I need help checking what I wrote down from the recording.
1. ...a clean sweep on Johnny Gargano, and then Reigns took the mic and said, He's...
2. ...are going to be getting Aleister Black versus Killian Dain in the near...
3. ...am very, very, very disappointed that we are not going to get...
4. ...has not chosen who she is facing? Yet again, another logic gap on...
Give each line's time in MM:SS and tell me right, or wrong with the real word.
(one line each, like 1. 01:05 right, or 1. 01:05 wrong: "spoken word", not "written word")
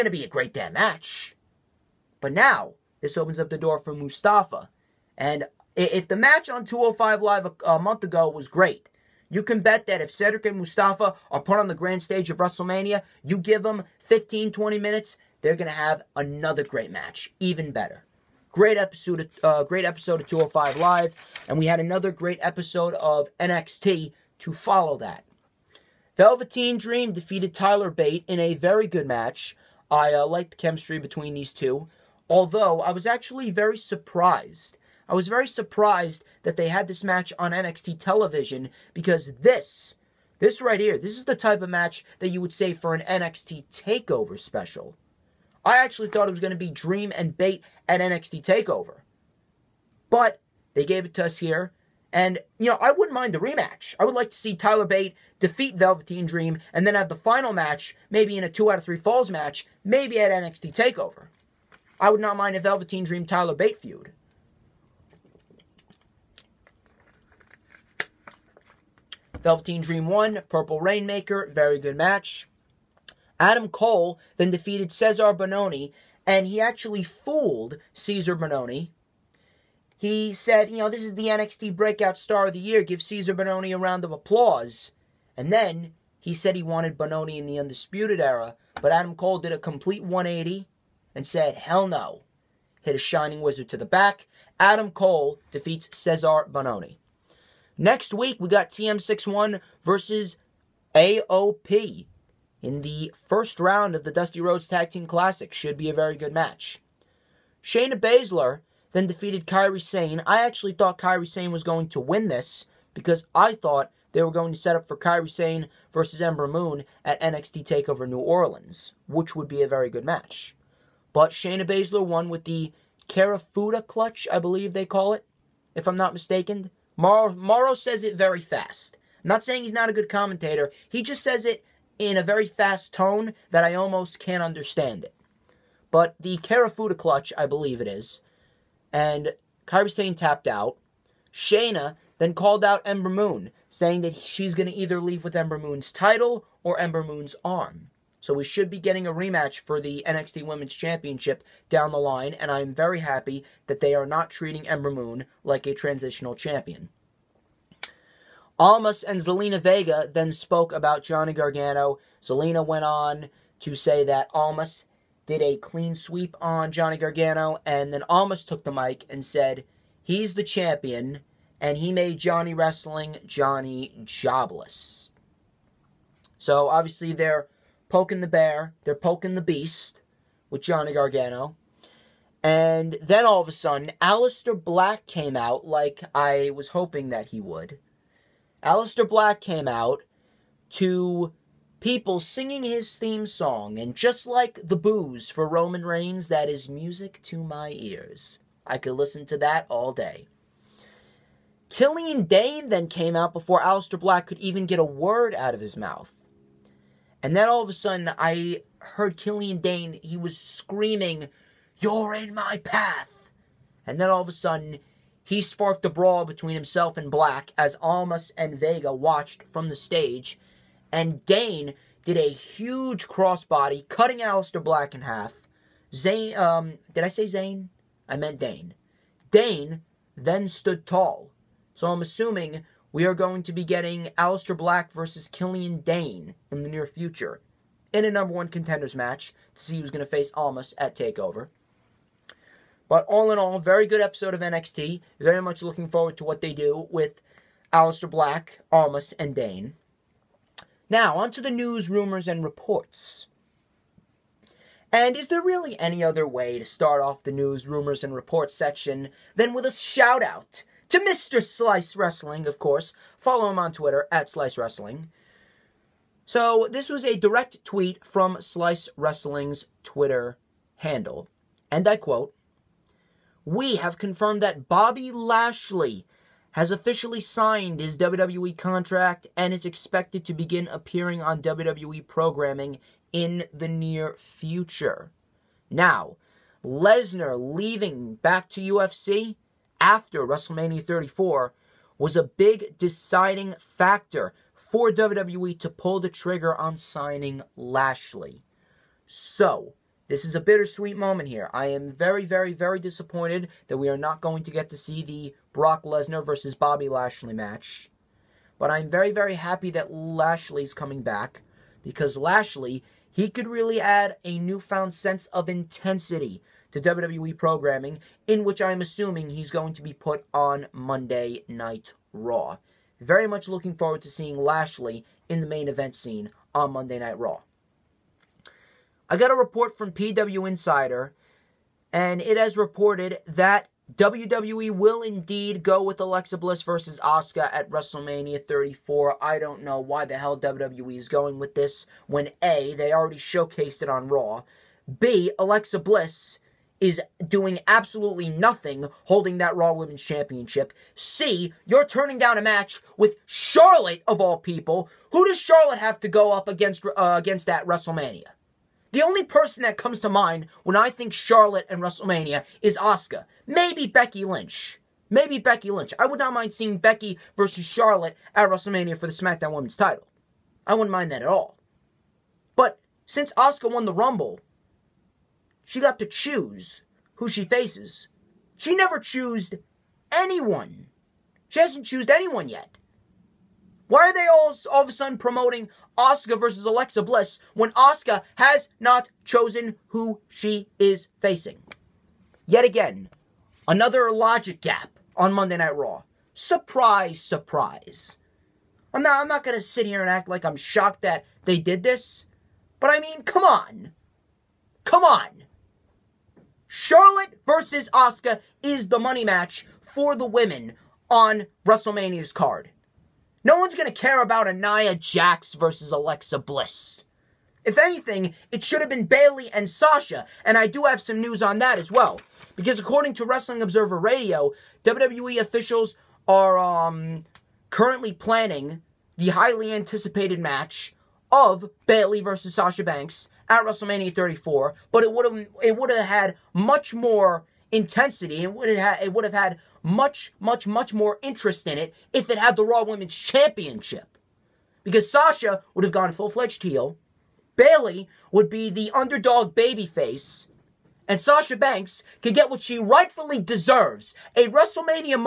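1. 02:45 wrong: "Almas", not "Reigns"
2. 03:53 right
3. 05:01 right
4. 06:28 right.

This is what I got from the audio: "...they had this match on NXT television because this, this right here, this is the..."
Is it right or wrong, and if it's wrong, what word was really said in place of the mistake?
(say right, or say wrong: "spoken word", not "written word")
right.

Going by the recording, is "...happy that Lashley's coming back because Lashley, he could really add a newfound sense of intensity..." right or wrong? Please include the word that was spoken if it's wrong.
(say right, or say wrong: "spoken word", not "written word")
right.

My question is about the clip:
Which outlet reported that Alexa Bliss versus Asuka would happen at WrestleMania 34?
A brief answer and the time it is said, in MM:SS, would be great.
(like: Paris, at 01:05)
PW Insider, at 05:29.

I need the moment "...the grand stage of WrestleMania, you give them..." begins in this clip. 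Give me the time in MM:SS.
00:11.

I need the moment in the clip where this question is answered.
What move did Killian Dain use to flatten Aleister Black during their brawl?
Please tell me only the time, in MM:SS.
03:43.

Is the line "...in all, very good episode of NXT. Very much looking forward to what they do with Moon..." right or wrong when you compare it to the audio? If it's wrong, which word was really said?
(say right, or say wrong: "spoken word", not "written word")
wrong: "Aleister", not "Moon".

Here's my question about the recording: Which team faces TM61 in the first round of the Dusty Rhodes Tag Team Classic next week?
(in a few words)
AOP.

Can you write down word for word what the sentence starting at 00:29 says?
I uh, like the chemistry between these two.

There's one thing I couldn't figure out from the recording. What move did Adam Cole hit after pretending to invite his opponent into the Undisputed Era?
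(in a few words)
Shining Wizard.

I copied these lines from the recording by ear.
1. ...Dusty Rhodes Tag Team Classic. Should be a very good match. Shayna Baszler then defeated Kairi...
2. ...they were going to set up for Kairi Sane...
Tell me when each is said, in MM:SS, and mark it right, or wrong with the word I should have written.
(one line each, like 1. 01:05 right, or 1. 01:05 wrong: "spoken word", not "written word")
1. 01:44 right
2. 01:54 right.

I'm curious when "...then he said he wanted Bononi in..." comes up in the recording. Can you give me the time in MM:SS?
01:25.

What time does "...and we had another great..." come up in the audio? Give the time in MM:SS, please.
00:21.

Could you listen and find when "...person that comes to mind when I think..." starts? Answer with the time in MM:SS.
05:59.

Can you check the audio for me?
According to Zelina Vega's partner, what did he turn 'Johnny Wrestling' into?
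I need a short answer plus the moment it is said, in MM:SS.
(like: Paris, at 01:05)
Johnny Jobless, at 02:53.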